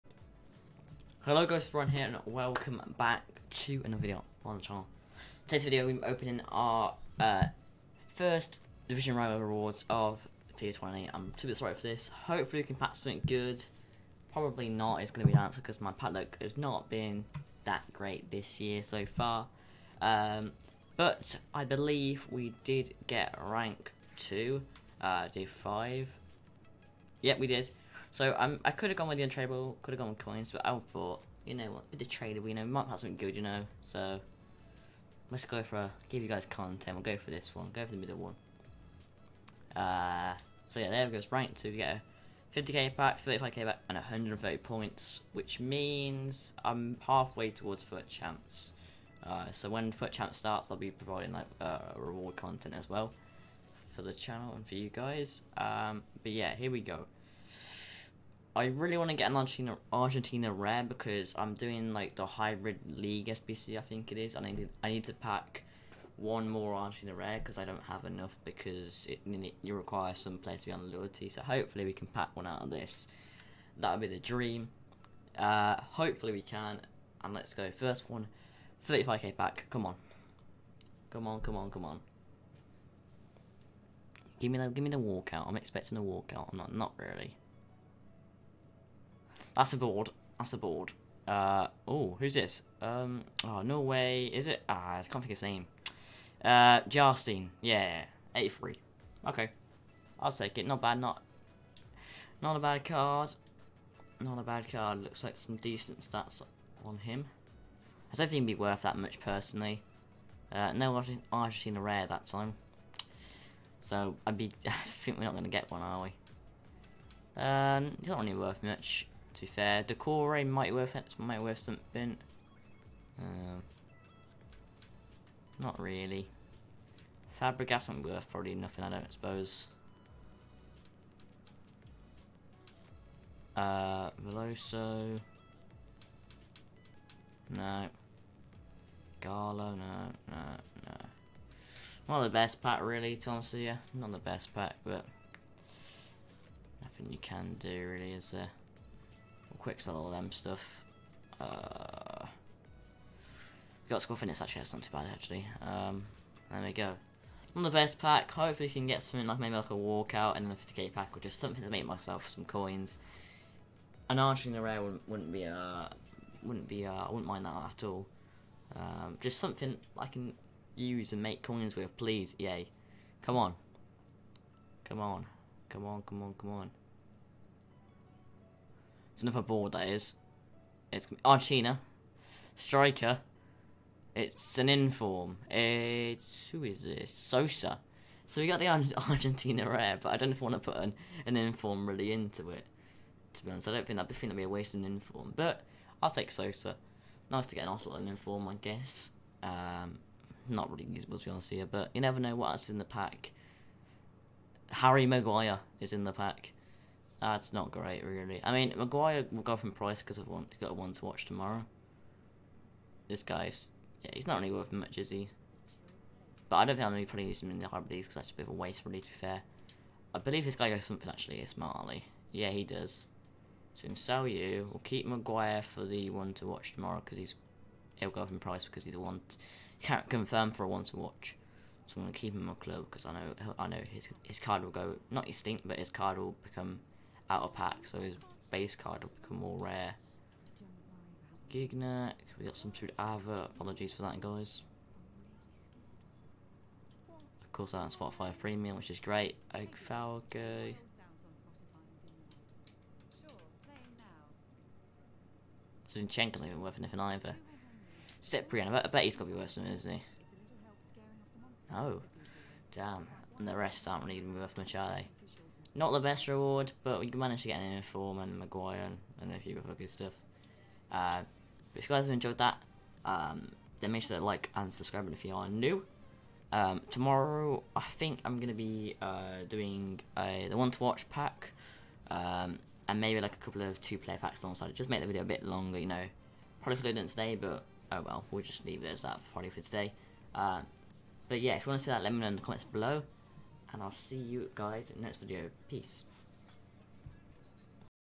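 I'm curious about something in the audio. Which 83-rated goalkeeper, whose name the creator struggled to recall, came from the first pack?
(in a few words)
Jarstein.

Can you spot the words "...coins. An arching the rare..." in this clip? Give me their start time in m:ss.
2:42.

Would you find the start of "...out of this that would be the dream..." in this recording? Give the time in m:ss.
1:12.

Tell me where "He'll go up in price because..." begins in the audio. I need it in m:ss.
3:47.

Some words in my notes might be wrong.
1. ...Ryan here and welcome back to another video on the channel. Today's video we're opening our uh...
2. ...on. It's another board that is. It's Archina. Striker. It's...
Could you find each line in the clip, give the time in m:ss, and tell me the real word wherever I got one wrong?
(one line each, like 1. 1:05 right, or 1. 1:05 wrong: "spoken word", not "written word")
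1. 0:01 right
2. 2:56 right.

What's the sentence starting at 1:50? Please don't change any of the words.
Uh, no Argentina rare that time.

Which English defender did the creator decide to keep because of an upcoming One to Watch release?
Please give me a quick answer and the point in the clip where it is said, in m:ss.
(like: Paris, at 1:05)
Harry Maguire, at 3:24.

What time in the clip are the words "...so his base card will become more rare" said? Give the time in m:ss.
3:57.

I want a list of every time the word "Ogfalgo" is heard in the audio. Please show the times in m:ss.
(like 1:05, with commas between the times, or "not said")
4:09.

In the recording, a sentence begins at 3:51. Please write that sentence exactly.
So I'm going to keep him in my club because I know I know his his card will go...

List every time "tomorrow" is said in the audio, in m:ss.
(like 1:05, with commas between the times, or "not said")
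3:31, 3:46, 4:36.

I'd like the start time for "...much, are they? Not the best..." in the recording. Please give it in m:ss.
4:24.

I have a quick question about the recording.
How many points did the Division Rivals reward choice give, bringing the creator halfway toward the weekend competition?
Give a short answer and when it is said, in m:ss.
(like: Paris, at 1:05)
130, at 0:43.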